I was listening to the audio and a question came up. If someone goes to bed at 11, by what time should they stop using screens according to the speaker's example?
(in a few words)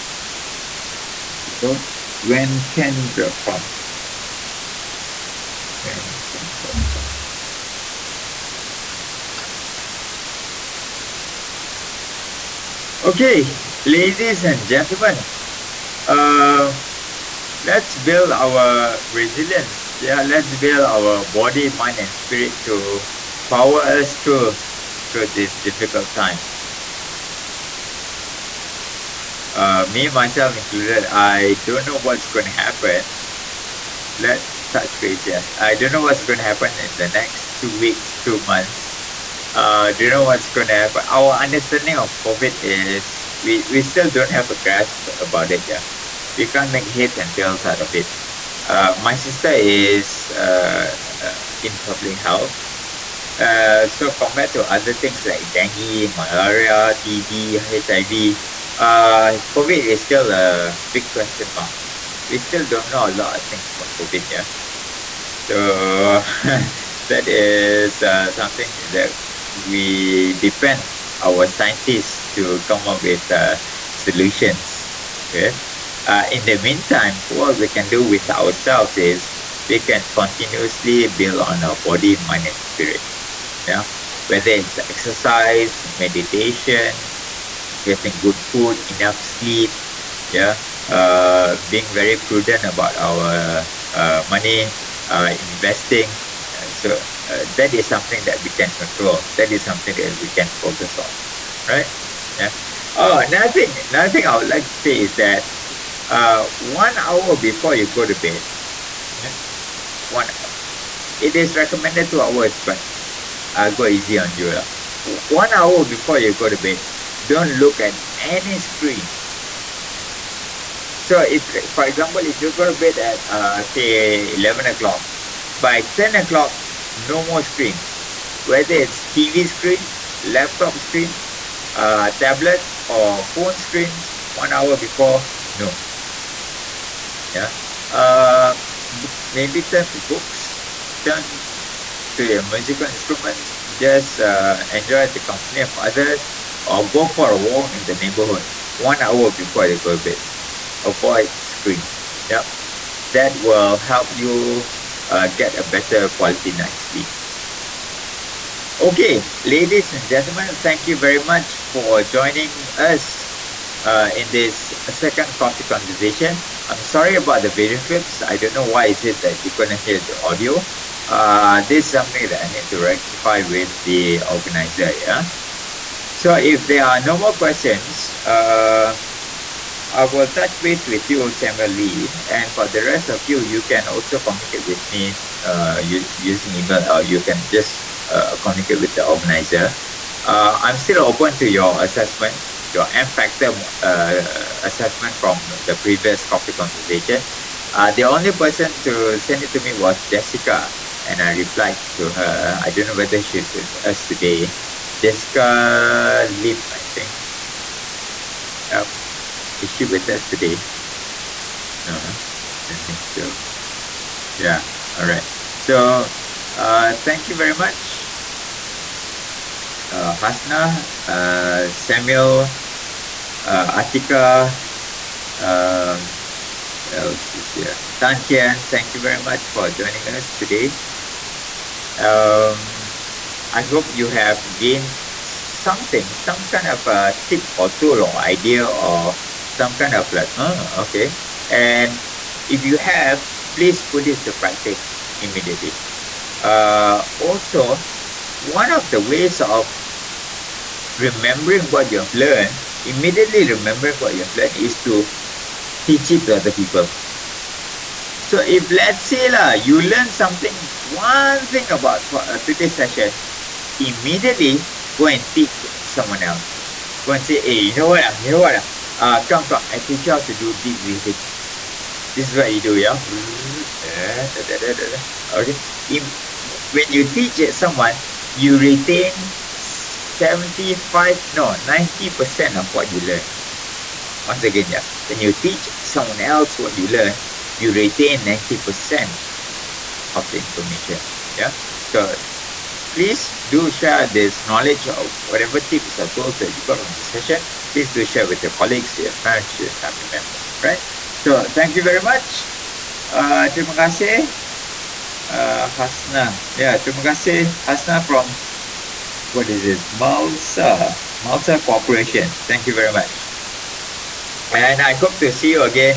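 10 o'clock.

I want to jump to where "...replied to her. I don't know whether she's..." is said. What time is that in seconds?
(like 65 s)
201 s.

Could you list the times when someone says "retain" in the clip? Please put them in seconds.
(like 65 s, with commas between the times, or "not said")
278 s, 287 s.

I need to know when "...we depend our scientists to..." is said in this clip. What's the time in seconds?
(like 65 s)
69 s.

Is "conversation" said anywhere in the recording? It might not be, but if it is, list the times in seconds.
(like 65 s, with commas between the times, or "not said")
165 s, 196 s.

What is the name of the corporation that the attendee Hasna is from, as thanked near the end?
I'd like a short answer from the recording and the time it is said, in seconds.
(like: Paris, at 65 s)
Malsa Corporation, at 311 s.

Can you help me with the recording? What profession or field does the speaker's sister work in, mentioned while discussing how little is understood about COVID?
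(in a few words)
public health.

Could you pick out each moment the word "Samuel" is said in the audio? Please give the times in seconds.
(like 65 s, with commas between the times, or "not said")
181 s, 221 s.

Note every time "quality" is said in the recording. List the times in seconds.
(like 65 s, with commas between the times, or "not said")
156 s.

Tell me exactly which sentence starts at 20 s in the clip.
Yeah, let's build our body, mind, and spirit to power us through through these difficult times.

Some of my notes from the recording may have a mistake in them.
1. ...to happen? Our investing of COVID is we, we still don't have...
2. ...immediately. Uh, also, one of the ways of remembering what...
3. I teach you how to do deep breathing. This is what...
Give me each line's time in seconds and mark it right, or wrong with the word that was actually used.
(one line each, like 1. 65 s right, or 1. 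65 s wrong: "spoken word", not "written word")
1. 40 s wrong: "understanding", not "investing"
2. 245 s right
3. 269 s right.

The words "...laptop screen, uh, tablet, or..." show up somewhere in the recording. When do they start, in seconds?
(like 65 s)
130 s.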